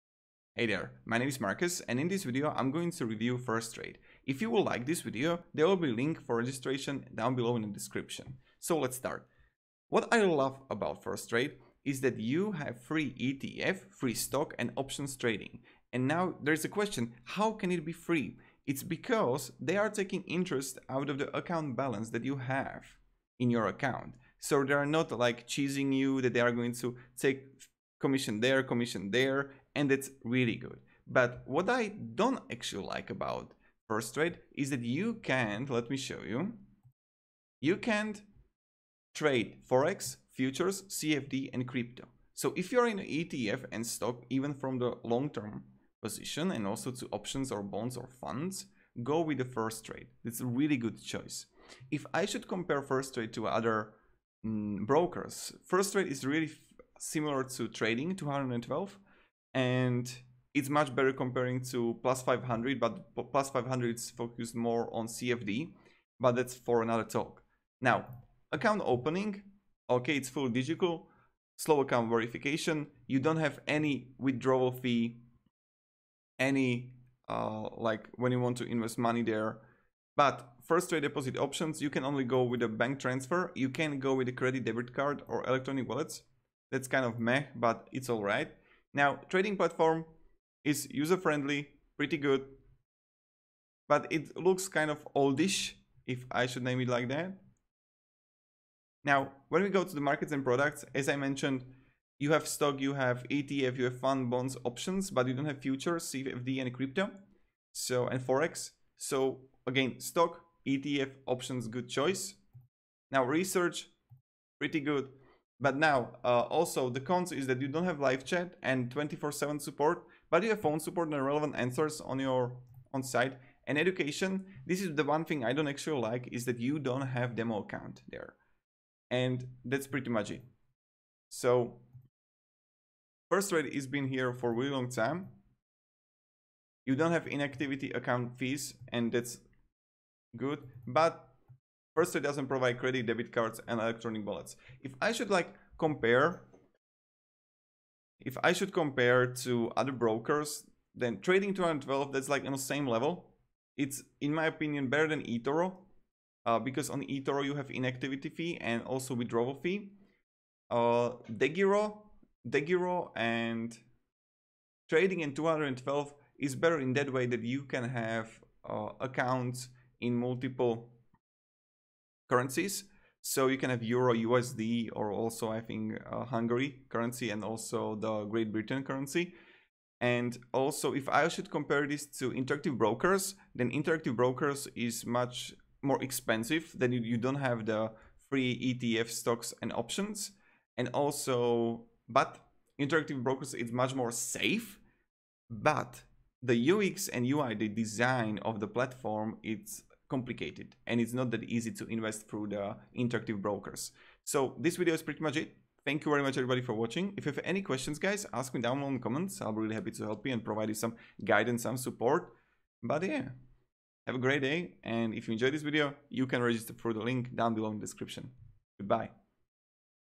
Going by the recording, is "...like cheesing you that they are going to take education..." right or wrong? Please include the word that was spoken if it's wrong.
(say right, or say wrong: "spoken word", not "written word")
wrong: "commission", not "education".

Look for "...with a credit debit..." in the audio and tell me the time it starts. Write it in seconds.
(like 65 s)
84 s.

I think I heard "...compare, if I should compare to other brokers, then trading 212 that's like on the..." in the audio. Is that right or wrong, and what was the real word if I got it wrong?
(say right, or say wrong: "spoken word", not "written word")
right.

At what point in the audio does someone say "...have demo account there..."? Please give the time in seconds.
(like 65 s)
127 s.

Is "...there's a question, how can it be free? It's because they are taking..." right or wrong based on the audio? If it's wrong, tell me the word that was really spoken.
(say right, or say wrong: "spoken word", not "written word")
right.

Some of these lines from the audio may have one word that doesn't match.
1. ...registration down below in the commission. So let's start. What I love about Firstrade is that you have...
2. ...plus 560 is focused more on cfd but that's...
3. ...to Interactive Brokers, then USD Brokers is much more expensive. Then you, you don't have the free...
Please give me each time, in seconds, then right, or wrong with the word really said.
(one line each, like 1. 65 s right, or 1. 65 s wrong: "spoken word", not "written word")
1. 6 s wrong: "description", not "commission"
2. 63 s wrong: "500", not "560"
3. 182 s wrong: "Interactive", not "USD".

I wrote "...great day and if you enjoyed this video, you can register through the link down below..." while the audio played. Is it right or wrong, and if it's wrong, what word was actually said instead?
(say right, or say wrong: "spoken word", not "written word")
right.